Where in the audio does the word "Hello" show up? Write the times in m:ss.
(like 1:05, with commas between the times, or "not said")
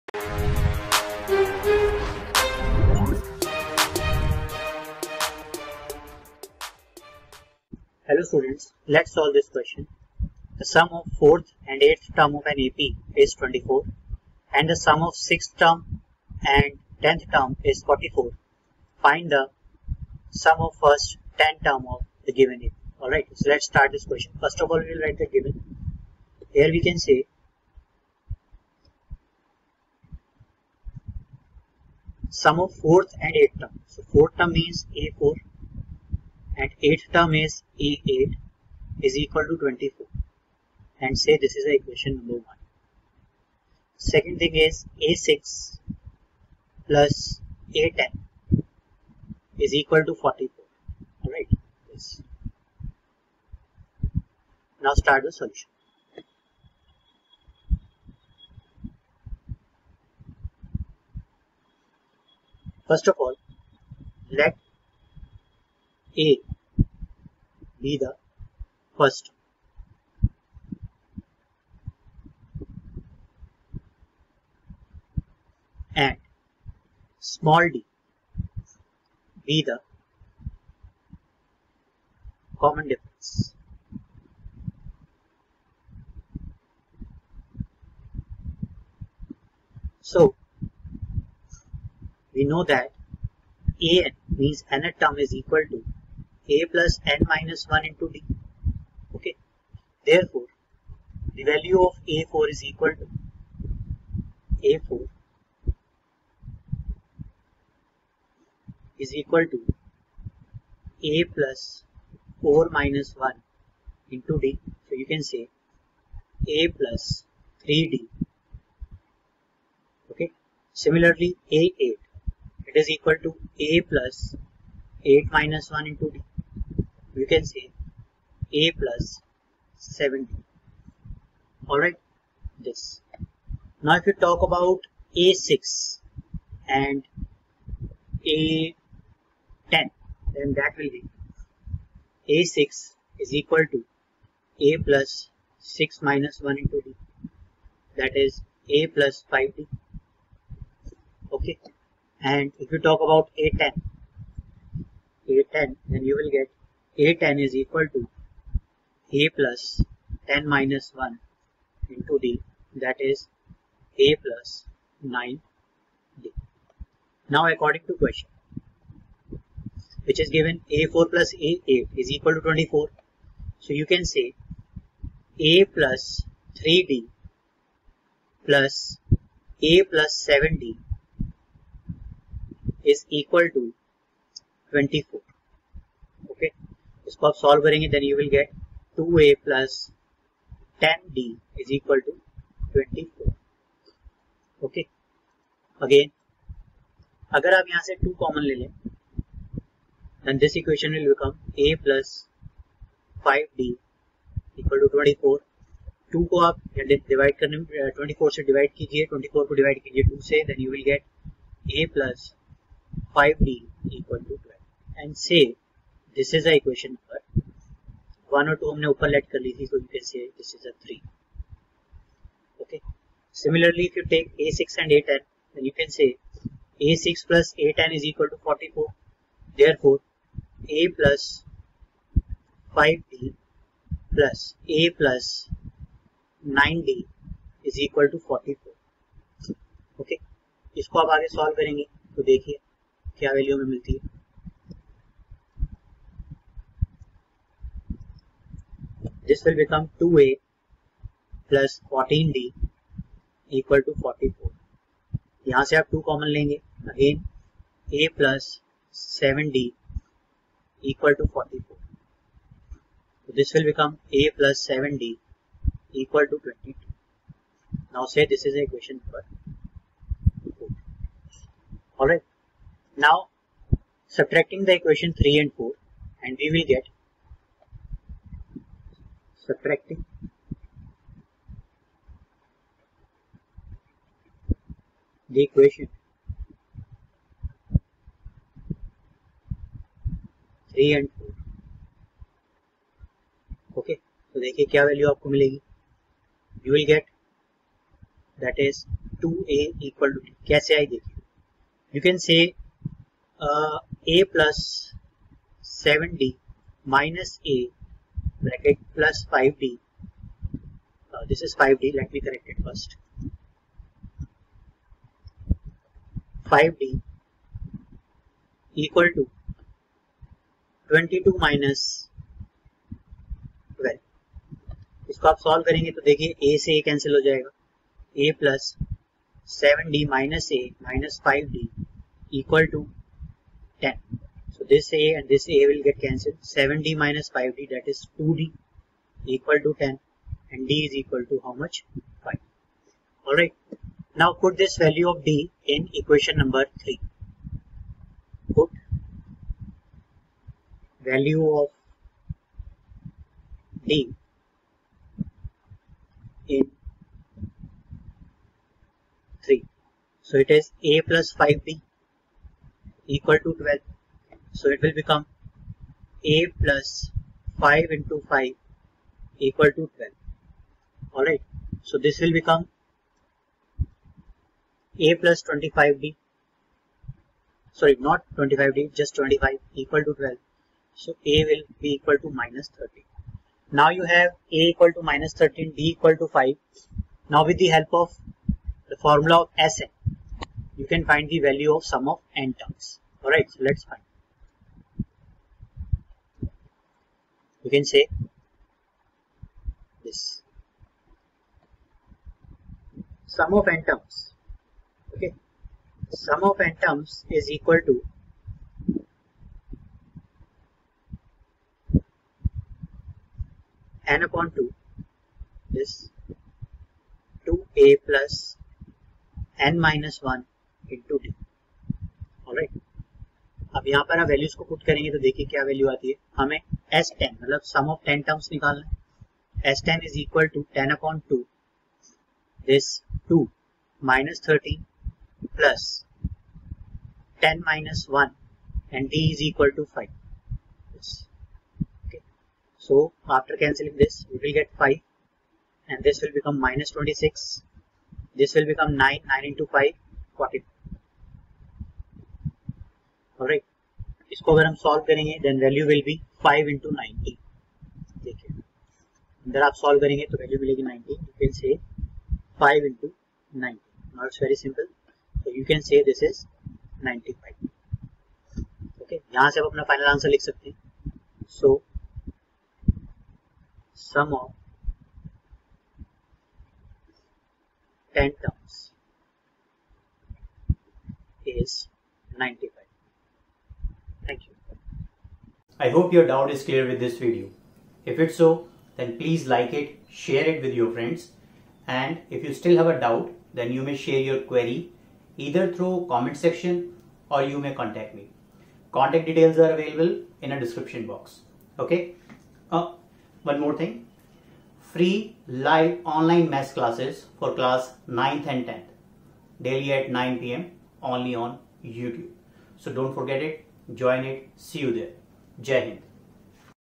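0:08.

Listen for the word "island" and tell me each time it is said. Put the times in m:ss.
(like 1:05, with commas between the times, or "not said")
not said.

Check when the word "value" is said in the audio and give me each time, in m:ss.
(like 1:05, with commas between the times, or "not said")
1:41, 5:44, 5:51, 6:31.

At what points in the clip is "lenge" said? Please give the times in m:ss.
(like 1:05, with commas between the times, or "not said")
4:16.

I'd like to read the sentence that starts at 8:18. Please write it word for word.
Contact details are available in a description box.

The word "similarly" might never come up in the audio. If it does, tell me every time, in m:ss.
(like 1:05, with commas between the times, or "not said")
2:00, 3:43.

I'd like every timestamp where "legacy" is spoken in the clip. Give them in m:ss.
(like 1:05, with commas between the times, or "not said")
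not said.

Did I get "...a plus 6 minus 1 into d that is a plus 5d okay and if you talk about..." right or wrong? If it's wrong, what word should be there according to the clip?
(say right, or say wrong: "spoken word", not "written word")
right.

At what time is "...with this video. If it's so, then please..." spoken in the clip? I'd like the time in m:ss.
8:06.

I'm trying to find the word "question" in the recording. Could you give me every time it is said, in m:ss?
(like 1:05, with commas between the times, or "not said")
0:09, 0:24, 2:47.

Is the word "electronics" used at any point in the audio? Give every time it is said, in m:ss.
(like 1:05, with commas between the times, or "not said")
not said.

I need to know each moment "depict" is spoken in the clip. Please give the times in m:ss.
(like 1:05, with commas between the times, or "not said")
not said.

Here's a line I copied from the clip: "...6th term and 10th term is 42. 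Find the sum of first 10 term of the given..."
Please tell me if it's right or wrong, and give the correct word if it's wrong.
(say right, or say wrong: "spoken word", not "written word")
wrong: "44", not "42".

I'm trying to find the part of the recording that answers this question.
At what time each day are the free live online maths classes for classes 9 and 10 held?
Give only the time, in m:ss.
8:30.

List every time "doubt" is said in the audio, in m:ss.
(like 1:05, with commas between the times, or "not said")
8:06, 8:12.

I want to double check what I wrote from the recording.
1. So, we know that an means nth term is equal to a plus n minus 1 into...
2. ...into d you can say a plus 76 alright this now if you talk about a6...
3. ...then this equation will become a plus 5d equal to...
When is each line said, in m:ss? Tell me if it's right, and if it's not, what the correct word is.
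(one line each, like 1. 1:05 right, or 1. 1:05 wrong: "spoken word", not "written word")
1. 1:30 right
2. 2:05 wrong: "70", not "76"
3. 3:20 right.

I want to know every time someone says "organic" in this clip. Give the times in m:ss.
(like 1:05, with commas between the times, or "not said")
not said.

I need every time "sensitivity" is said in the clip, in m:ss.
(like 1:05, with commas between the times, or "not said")
not said.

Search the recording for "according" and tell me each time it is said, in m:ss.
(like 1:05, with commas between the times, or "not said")
2:47.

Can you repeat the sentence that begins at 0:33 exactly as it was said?
So 4th term means A4 and 8th term is A8 is equal to 24 and say this is the equation number 1.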